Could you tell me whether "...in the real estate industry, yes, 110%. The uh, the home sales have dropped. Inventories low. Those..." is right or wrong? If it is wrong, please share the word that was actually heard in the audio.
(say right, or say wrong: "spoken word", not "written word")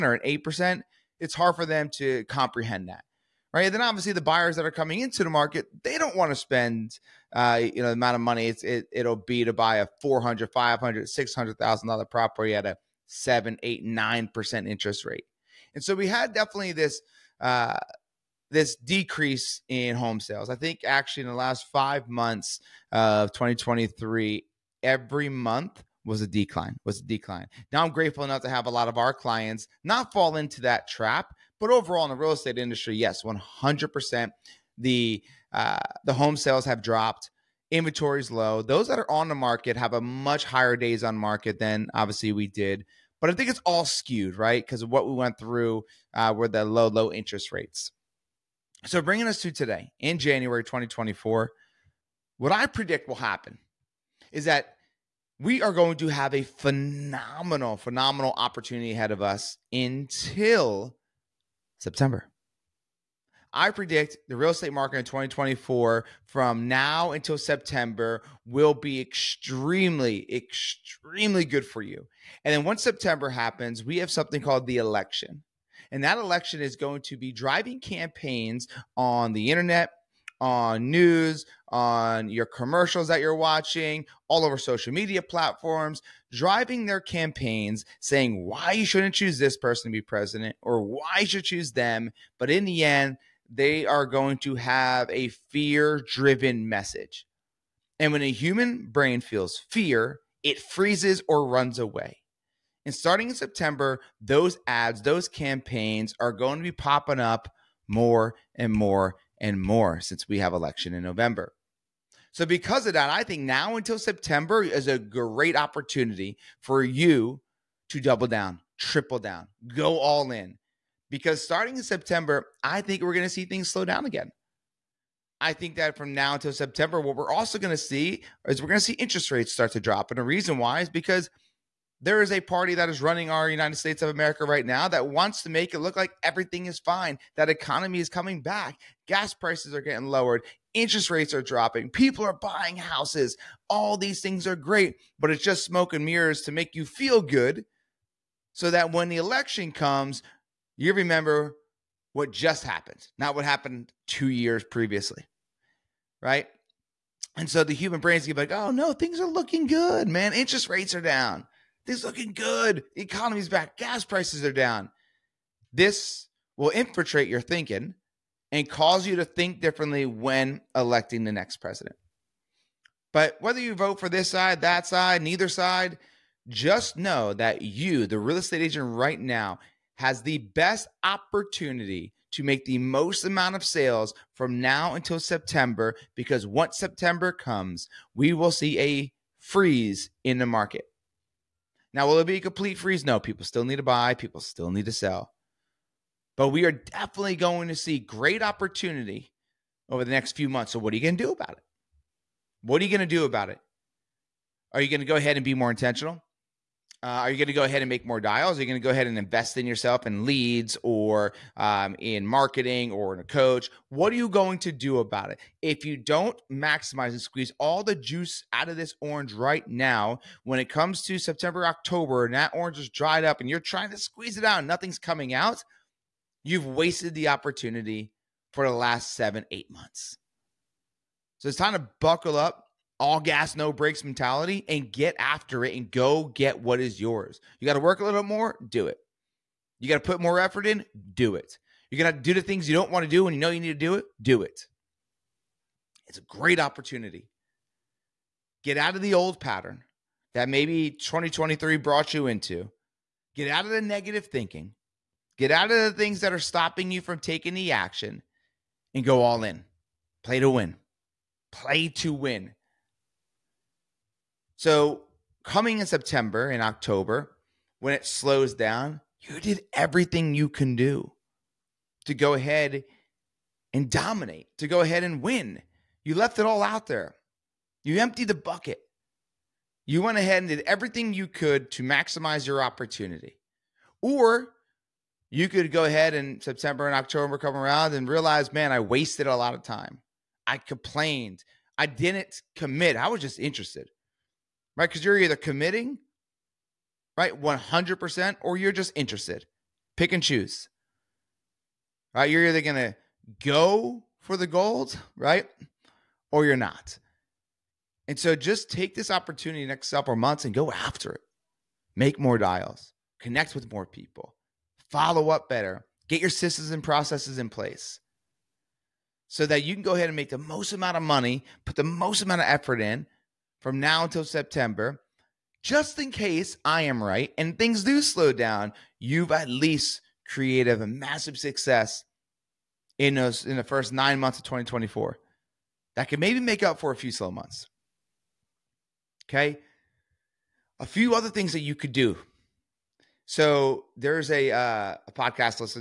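wrong: "100", not "110".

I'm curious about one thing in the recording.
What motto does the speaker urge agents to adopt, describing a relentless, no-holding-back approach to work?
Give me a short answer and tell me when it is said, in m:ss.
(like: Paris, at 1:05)
All gas, no brakes, at 3:53.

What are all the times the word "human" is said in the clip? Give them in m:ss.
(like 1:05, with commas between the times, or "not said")
1:38, 2:37.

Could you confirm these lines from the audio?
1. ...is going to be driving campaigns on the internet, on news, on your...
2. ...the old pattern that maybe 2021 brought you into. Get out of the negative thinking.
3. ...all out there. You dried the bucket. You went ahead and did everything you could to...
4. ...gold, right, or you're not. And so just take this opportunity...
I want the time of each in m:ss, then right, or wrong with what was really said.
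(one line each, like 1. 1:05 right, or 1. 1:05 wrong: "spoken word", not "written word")
1. 1:16 right
2. 4:09 wrong: "2023", not "2021"
3. 4:36 wrong: "emptied", not "dried"
4. 5:04 right.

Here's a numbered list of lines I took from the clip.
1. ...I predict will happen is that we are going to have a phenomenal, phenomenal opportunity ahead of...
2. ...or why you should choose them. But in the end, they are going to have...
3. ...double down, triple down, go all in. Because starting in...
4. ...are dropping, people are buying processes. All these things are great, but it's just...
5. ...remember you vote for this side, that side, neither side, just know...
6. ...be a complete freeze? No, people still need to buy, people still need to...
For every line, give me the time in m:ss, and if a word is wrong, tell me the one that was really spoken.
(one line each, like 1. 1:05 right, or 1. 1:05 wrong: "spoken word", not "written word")
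1. 0:52 right
2. 1:30 right
3. 1:57 right
4. 2:21 wrong: "houses", not "processes"
5. 2:53 wrong: "whether", not "remember"
6. 3:12 right.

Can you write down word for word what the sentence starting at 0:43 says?
But I think it's all skewed, right?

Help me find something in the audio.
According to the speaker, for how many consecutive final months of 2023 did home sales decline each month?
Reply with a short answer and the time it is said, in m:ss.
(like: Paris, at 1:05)
5, at 0:21.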